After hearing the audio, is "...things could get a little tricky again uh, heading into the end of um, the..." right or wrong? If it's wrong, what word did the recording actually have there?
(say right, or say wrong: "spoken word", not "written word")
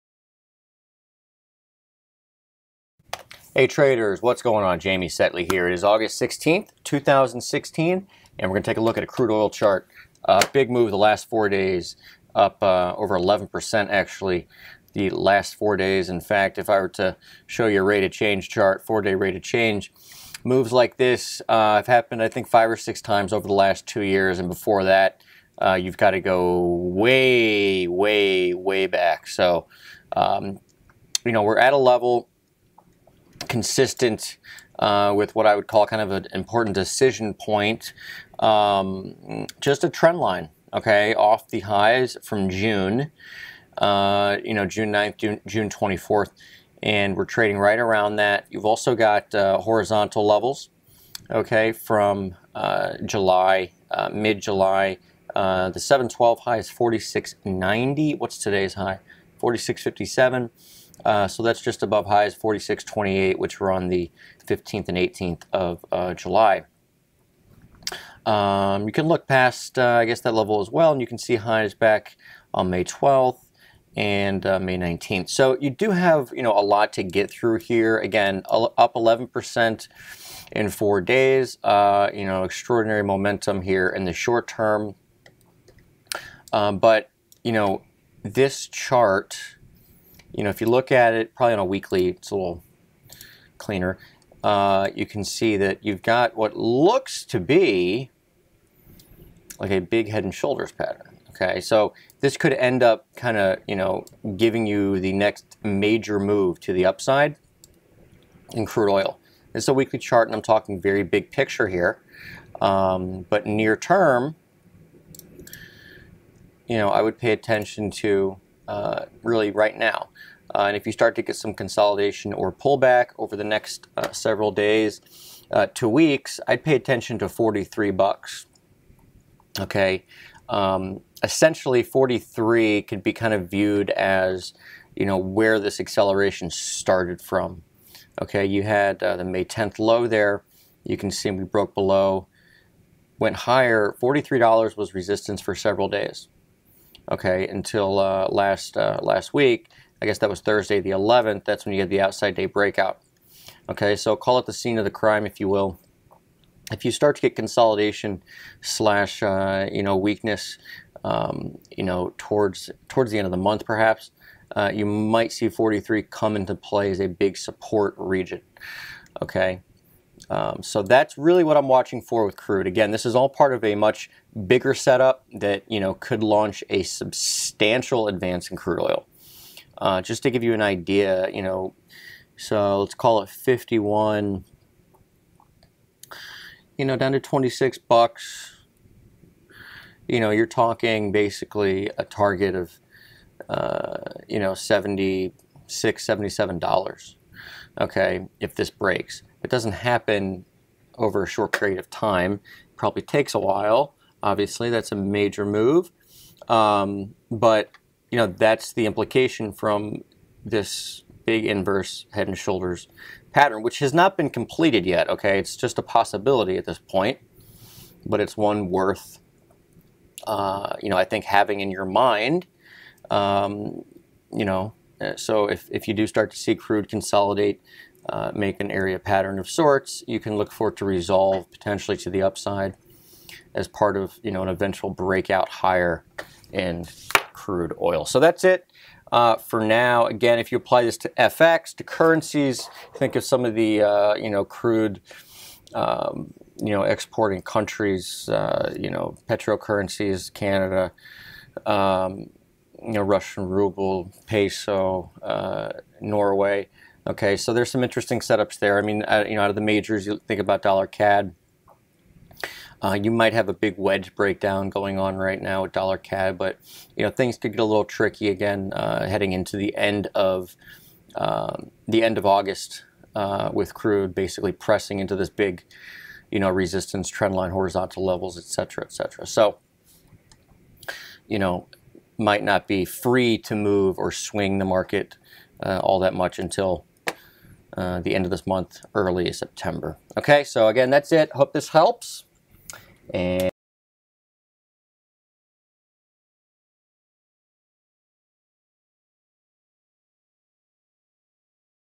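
right.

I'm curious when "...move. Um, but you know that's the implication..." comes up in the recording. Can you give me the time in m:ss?
3:25.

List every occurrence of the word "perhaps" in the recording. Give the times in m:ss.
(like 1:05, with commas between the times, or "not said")
2:43.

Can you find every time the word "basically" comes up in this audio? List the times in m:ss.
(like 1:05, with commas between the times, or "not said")
3:11, 4:34.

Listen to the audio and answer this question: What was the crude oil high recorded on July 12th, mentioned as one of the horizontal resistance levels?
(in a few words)
46.90.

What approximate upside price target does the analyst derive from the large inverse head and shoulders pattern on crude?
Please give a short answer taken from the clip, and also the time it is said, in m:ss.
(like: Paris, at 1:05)
76 to 77 dollars, at 3:14.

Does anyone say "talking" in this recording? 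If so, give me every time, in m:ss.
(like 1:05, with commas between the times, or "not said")
1:50, 3:10.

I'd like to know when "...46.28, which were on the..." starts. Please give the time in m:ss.
1:02.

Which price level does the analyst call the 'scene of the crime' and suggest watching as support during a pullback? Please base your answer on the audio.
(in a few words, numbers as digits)
$43.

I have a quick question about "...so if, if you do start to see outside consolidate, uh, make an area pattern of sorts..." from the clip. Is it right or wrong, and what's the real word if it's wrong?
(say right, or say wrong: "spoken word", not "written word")
wrong: "crude", not "outside".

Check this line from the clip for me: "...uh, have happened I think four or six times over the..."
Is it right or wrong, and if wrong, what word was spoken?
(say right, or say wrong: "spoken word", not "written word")
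wrong: "five", not "four".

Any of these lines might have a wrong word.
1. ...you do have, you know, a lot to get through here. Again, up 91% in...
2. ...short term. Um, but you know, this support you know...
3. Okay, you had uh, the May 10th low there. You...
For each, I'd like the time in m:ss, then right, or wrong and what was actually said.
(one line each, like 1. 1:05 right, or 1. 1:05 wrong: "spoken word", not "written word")
1. 1:15 wrong: "11", not "91"
2. 1:24 wrong: "chart", not "support"
3. 2:18 right.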